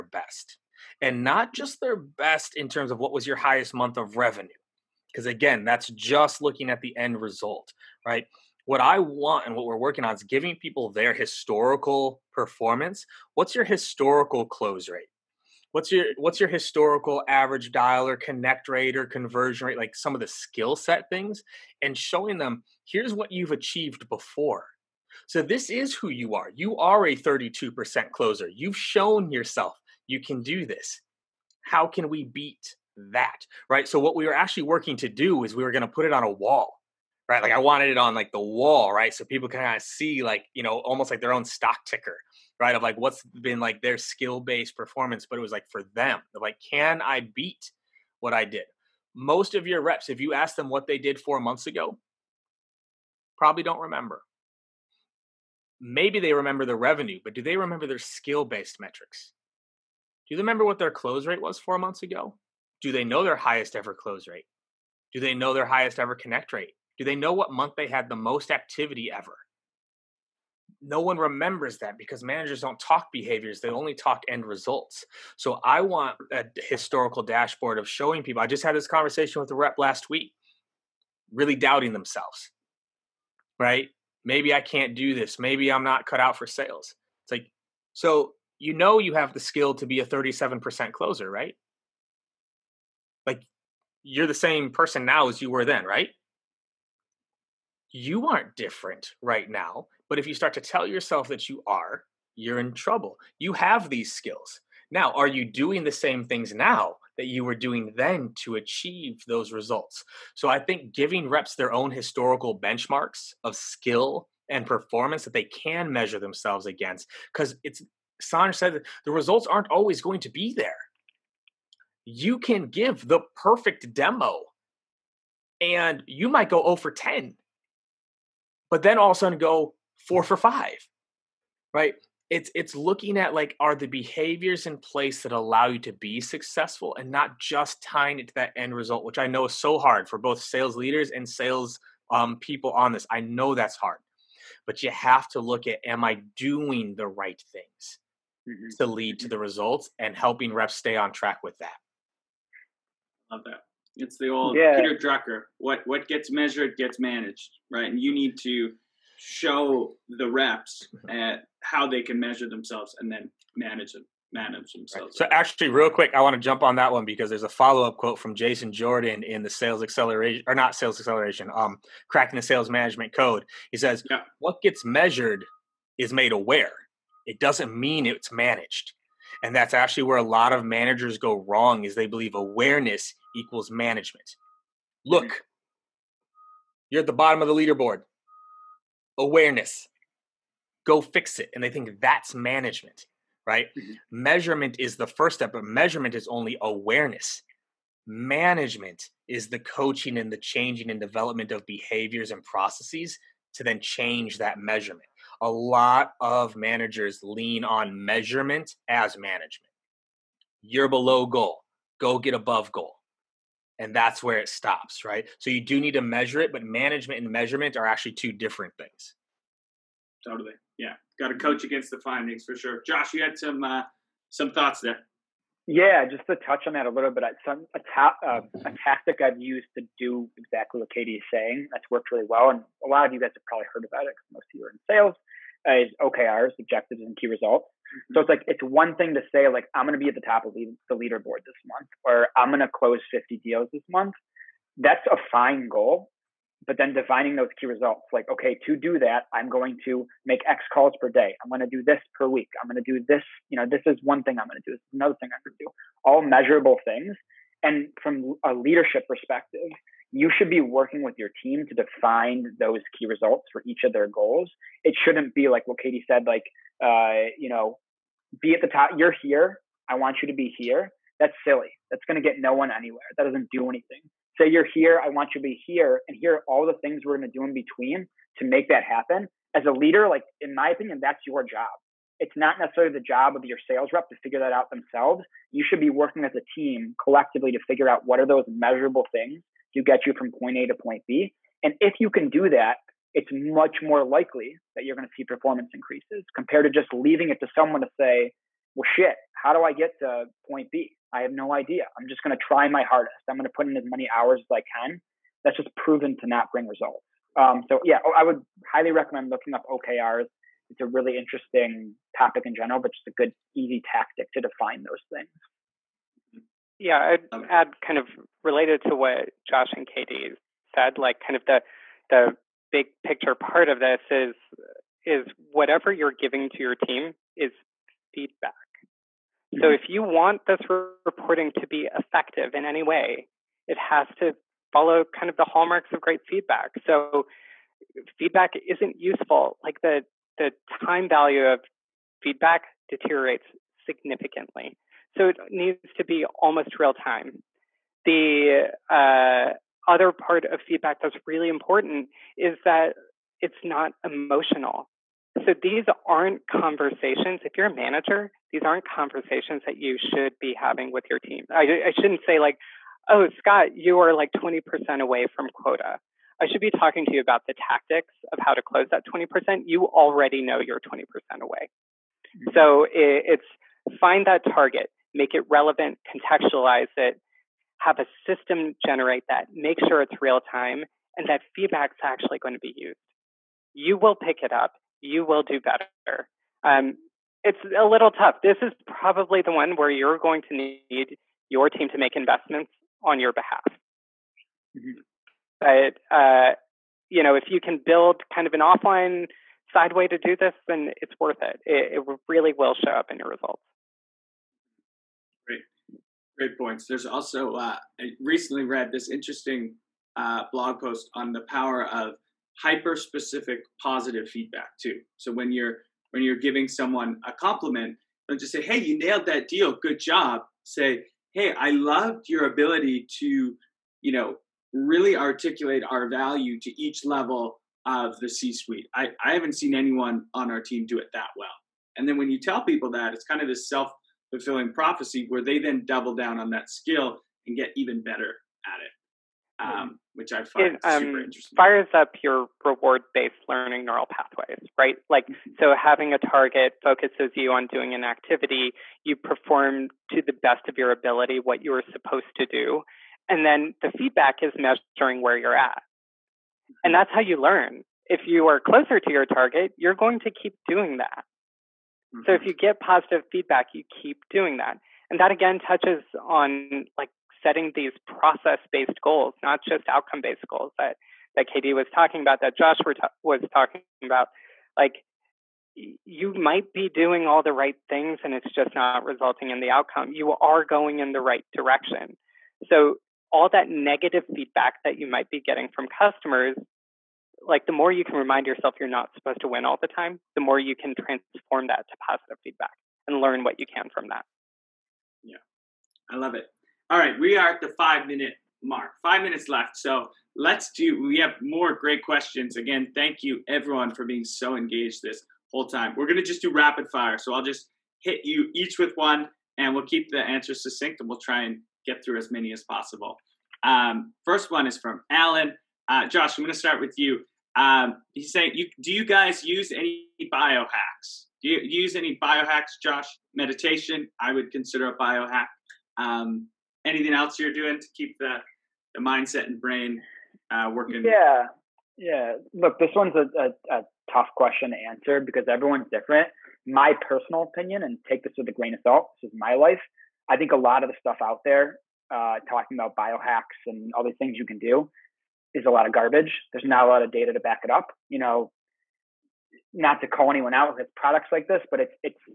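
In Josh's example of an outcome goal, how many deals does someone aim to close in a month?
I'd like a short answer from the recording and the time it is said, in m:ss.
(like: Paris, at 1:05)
50, at 4:03.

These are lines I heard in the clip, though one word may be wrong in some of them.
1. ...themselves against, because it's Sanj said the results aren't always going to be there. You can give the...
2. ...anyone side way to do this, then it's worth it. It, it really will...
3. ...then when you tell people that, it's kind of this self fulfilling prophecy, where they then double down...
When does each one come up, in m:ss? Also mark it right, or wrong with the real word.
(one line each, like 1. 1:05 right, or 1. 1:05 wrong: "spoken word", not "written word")
1. 1:56 right
2. 6:38 wrong: "offline", not "anyone"
3. 7:12 right.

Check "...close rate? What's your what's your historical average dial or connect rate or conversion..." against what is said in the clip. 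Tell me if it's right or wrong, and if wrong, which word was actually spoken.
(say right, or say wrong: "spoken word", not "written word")
right.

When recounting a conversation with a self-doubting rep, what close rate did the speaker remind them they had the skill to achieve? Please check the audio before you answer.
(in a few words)
37%.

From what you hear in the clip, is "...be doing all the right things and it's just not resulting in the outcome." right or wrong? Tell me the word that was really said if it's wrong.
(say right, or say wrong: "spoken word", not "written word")
right.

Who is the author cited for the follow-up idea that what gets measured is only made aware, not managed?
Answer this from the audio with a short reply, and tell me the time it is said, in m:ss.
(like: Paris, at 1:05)
Jason Jordan, at 2:48.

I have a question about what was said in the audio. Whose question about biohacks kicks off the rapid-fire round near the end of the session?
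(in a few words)
Alan.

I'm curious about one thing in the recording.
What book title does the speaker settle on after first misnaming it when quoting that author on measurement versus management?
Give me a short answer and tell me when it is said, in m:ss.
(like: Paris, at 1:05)
Cracking the Sales Management Code, at 2:52.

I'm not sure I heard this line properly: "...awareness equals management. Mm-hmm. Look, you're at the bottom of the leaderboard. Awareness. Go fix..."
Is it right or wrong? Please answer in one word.
right.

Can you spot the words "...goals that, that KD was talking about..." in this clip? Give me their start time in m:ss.
7:50.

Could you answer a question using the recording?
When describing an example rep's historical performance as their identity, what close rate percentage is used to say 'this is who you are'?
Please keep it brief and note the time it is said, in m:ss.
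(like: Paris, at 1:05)
32%, at 0:27.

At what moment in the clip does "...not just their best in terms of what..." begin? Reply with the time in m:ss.
0:01.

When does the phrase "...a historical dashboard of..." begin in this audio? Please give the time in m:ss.
1:16.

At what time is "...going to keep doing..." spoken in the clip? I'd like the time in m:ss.
7:39.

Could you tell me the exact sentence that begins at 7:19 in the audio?
Um, which I find it, um, super interesting.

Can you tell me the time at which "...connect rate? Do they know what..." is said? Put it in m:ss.
1:06.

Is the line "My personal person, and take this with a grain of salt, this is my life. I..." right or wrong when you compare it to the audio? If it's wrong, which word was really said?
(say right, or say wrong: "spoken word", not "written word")
wrong: "opinion", not "person".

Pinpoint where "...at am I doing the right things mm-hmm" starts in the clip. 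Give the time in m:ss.
2:25.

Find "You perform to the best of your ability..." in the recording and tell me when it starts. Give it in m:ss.
7:29.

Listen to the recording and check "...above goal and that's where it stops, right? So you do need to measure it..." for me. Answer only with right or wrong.
right.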